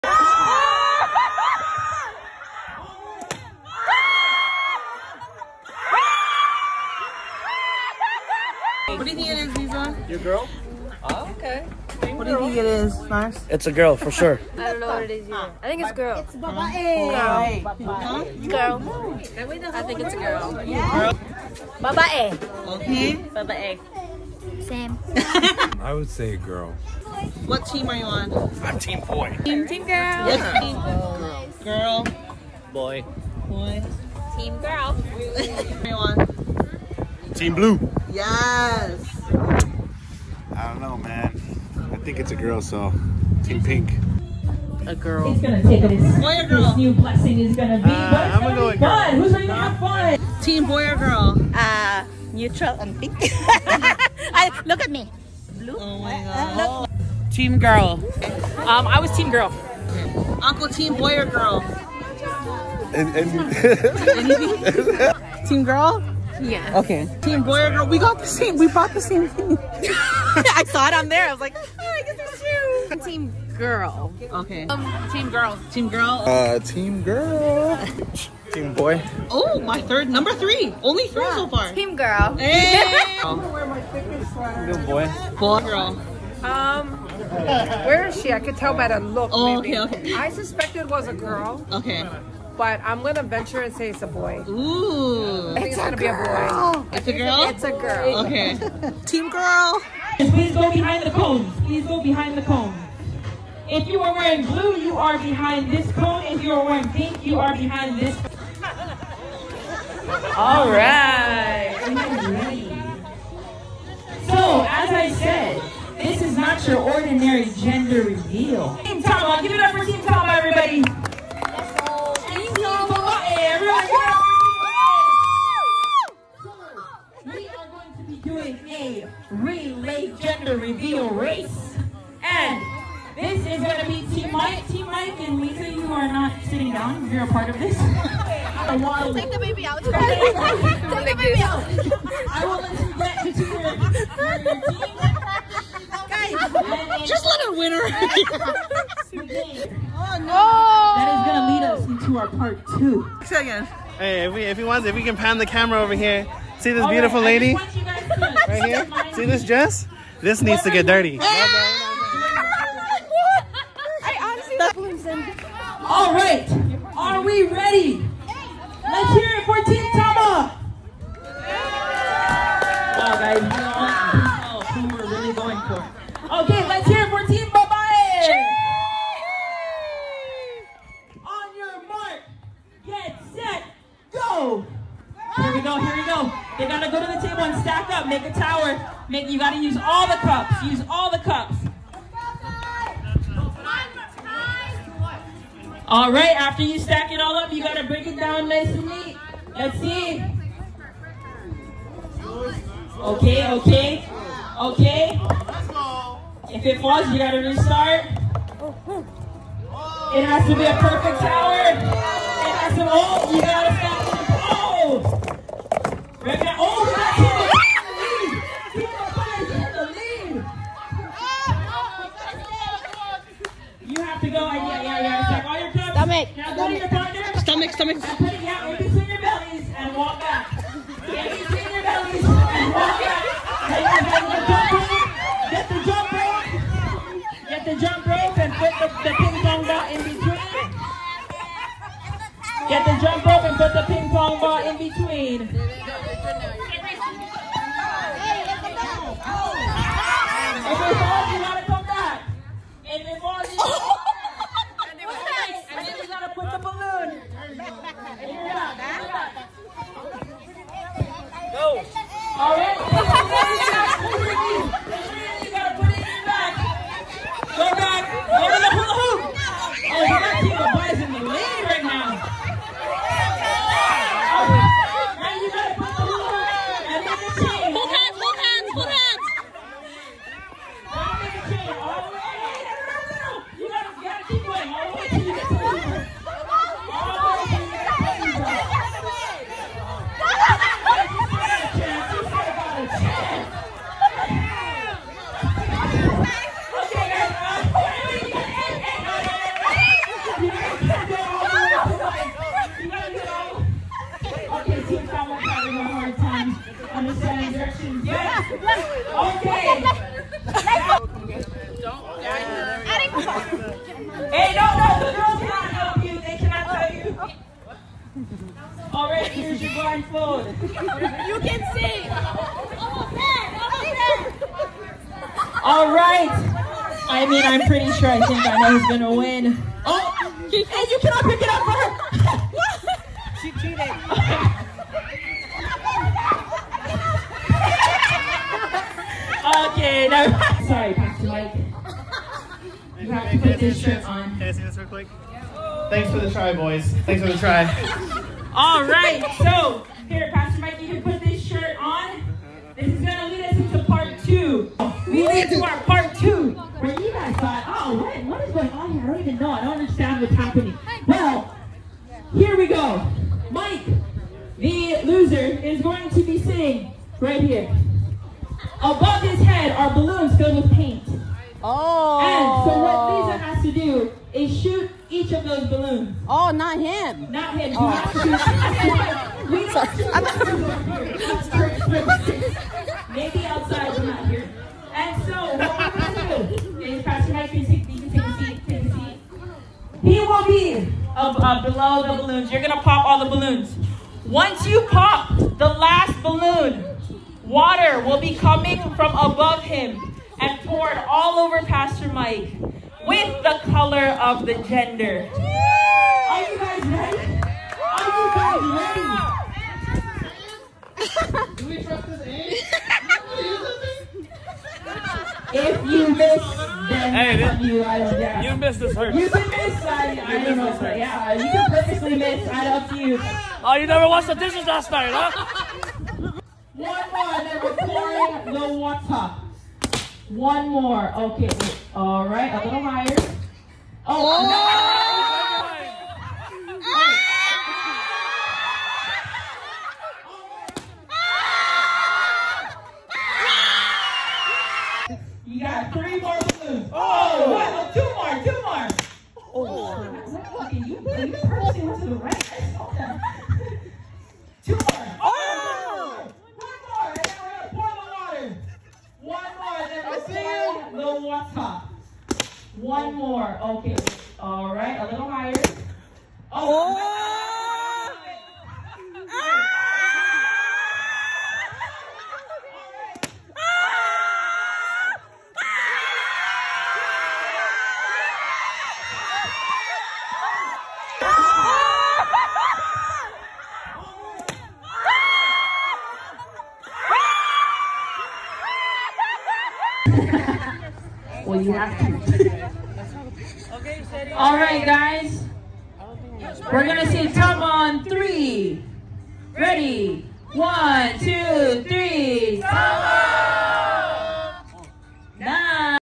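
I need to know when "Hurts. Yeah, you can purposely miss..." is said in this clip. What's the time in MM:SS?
07:00.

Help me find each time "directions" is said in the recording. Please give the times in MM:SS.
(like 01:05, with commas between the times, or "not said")
05:07.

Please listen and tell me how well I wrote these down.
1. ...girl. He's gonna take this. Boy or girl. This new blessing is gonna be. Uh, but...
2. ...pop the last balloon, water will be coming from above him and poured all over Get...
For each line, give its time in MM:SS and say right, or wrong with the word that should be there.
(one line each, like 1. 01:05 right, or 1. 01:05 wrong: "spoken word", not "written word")
1. 00:44 right
2. 06:34 wrong: "Pastor", not "Get".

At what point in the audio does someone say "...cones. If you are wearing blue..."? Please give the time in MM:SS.
01:42.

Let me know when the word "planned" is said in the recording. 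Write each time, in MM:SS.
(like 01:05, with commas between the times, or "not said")
not said.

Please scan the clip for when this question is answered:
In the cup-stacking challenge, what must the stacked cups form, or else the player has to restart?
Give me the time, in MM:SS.
03:30.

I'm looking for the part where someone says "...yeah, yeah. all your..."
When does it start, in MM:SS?
03:44.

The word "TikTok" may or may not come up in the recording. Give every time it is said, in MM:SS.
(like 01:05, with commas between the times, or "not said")
02:49.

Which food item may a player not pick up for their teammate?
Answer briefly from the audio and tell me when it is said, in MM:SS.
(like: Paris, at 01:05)
Cookie, at 05:30.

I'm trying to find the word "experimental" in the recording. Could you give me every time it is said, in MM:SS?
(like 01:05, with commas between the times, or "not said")
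not said.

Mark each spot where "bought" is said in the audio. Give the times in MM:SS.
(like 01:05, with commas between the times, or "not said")
01:08.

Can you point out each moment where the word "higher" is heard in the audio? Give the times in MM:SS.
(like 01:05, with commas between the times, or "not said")
07:12, 07:45.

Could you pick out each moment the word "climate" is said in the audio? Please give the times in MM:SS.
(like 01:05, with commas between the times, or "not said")
not said.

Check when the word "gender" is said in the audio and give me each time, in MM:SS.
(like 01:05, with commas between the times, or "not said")
01:57, 02:10, 06:44.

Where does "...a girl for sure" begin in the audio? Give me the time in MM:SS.
00:13.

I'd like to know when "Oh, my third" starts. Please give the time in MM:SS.
01:19.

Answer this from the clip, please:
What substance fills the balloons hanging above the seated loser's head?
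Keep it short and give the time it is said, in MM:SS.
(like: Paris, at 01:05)
Paint, at 06:10.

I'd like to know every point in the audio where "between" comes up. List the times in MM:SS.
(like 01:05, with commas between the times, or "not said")
04:00, 04:04.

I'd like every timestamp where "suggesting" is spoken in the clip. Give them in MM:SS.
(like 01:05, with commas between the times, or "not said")
not said.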